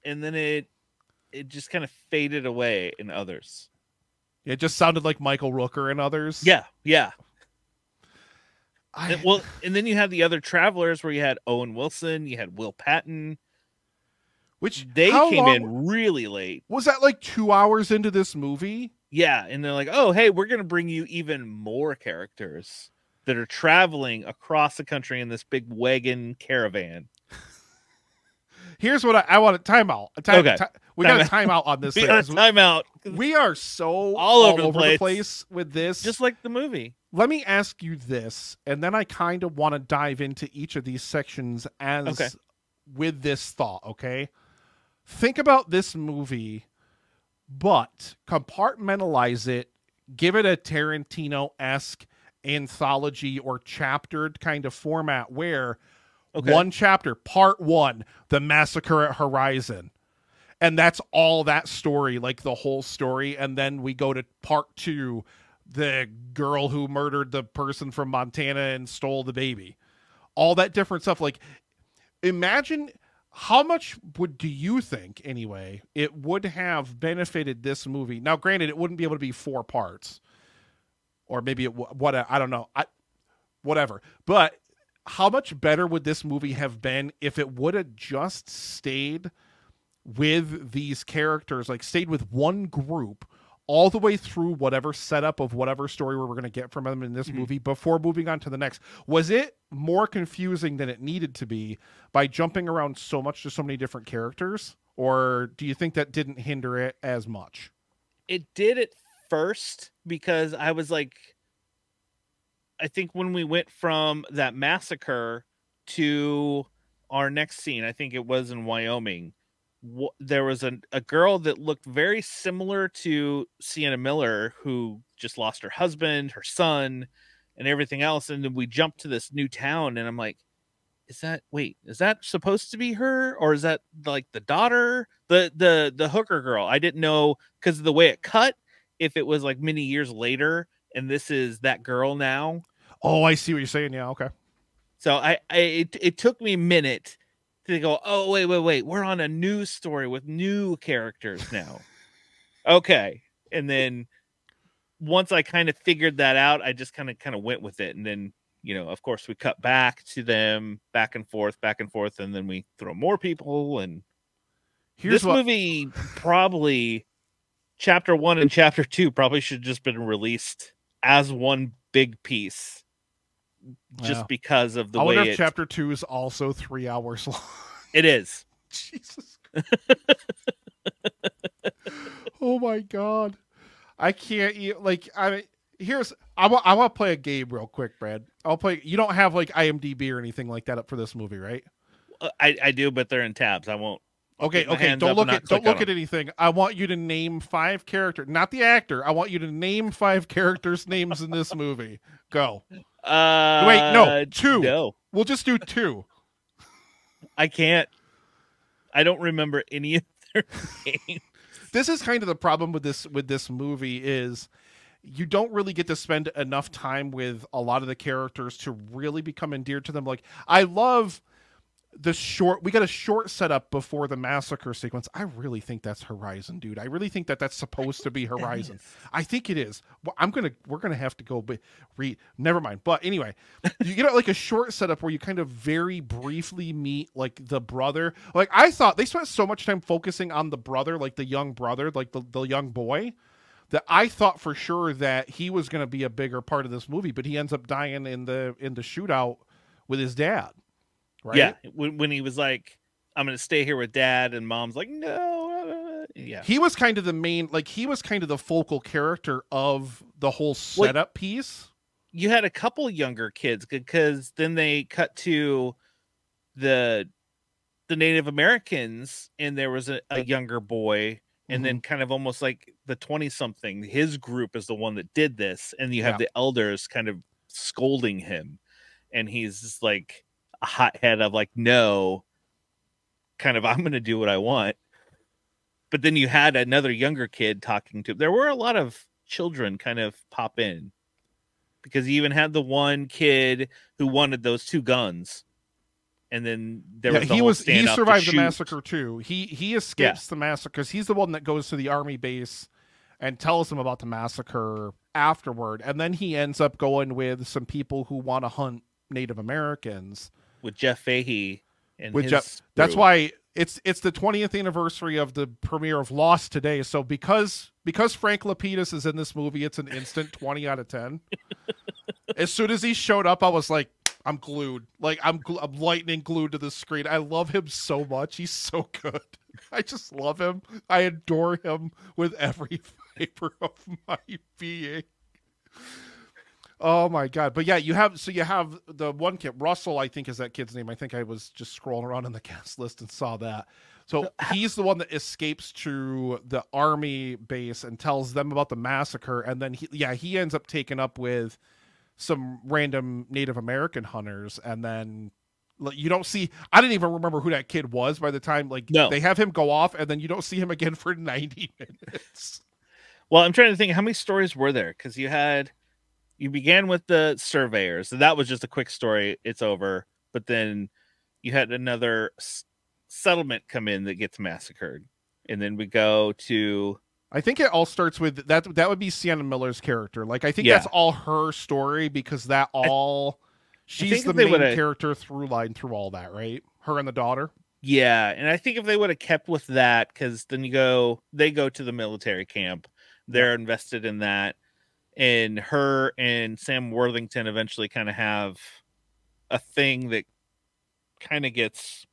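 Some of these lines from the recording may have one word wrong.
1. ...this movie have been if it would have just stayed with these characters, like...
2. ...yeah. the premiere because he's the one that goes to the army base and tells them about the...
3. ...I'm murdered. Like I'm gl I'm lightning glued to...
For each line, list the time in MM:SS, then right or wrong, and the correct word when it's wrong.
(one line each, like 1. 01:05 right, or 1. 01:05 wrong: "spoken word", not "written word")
1. 01:26 right
2. 05:00 wrong: "massacre", not "premiere"
3. 05:24 wrong: "glued", not "murdered".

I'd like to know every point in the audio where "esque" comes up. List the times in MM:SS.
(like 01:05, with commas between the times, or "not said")
00:51.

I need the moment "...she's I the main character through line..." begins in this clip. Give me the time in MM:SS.
06:23.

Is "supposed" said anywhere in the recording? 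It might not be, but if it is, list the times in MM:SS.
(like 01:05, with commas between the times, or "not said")
02:12, 03:47.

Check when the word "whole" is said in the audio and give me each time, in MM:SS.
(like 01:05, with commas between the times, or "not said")
01:02, 04:20.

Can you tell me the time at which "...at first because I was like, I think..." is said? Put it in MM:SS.
01:48.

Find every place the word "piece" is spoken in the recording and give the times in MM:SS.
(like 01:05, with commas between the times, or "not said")
02:52, 04:21.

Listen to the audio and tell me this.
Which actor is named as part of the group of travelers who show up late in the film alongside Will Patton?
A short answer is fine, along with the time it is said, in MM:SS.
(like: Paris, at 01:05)
Owen Wilson, at 00:11.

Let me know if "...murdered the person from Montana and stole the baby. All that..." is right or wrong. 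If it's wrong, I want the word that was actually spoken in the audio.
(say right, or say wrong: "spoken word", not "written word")
right.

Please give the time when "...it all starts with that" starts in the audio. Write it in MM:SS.
06:17.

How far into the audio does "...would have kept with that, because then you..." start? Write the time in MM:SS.
06:28.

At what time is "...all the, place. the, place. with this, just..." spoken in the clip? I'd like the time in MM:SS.
00:34.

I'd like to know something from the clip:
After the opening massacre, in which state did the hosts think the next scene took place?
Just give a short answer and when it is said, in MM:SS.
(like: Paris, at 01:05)
Wyoming, at 01:58.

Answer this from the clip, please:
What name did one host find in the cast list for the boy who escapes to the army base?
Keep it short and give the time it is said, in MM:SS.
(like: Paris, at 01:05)
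Russell, at 05:39.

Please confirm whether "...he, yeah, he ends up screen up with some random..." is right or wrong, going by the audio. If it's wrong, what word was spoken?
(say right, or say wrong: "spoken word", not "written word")
wrong: "taken", not "screen".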